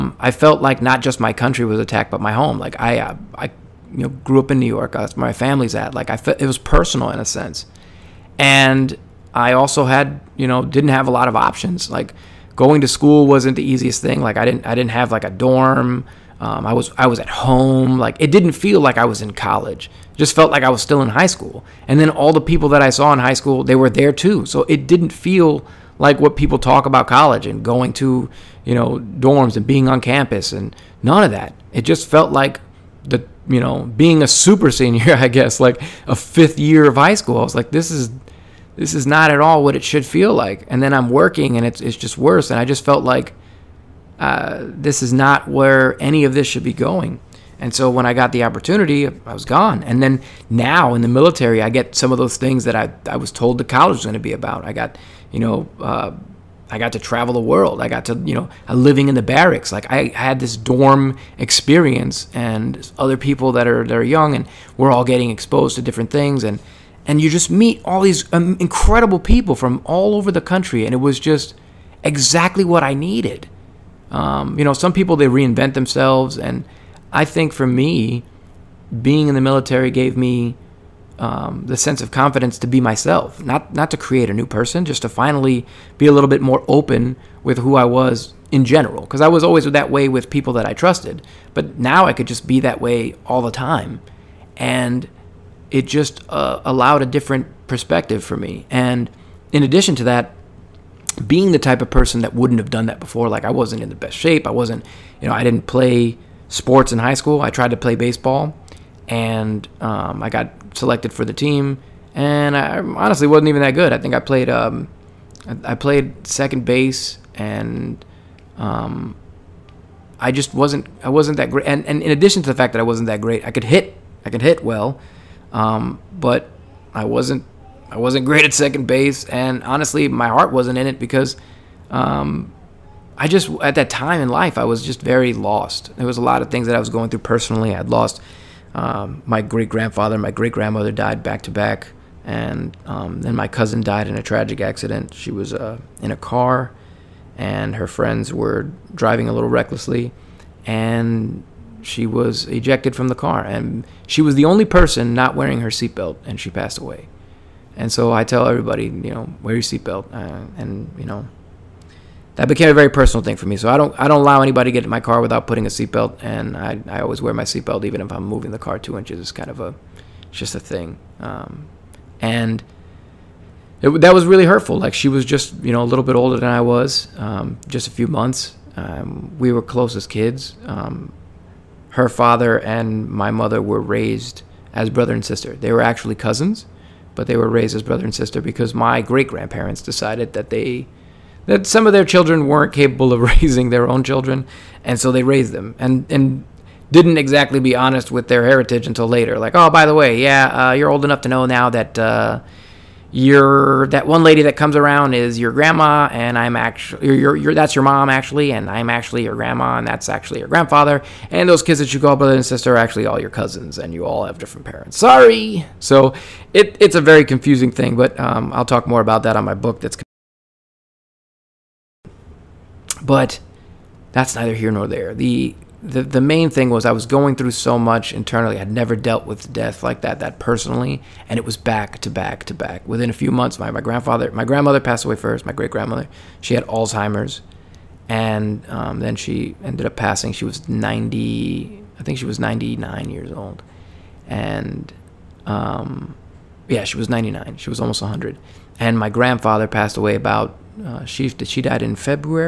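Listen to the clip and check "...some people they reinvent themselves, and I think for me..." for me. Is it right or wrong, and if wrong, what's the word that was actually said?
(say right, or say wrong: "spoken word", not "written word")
right.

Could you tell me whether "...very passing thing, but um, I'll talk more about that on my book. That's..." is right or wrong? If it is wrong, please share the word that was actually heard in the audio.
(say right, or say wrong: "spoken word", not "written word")
wrong: "confusing", not "passing".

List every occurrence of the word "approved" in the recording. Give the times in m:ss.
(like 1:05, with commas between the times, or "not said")
not said.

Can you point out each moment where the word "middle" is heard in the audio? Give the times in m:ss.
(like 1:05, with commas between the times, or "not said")
not said.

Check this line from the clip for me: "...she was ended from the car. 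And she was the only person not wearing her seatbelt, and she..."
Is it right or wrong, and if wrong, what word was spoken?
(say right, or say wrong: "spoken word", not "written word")
wrong: "ejected", not "ended".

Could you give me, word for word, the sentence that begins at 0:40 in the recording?
And then I'm working and it's, it's just worse.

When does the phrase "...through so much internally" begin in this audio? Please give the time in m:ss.
3:47.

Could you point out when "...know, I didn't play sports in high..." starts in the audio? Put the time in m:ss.
1:45.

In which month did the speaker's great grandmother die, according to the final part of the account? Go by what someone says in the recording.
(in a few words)
February.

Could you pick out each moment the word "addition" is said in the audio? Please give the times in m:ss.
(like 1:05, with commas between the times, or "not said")
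1:39, 2:02.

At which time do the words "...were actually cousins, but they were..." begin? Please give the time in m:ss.
3:05.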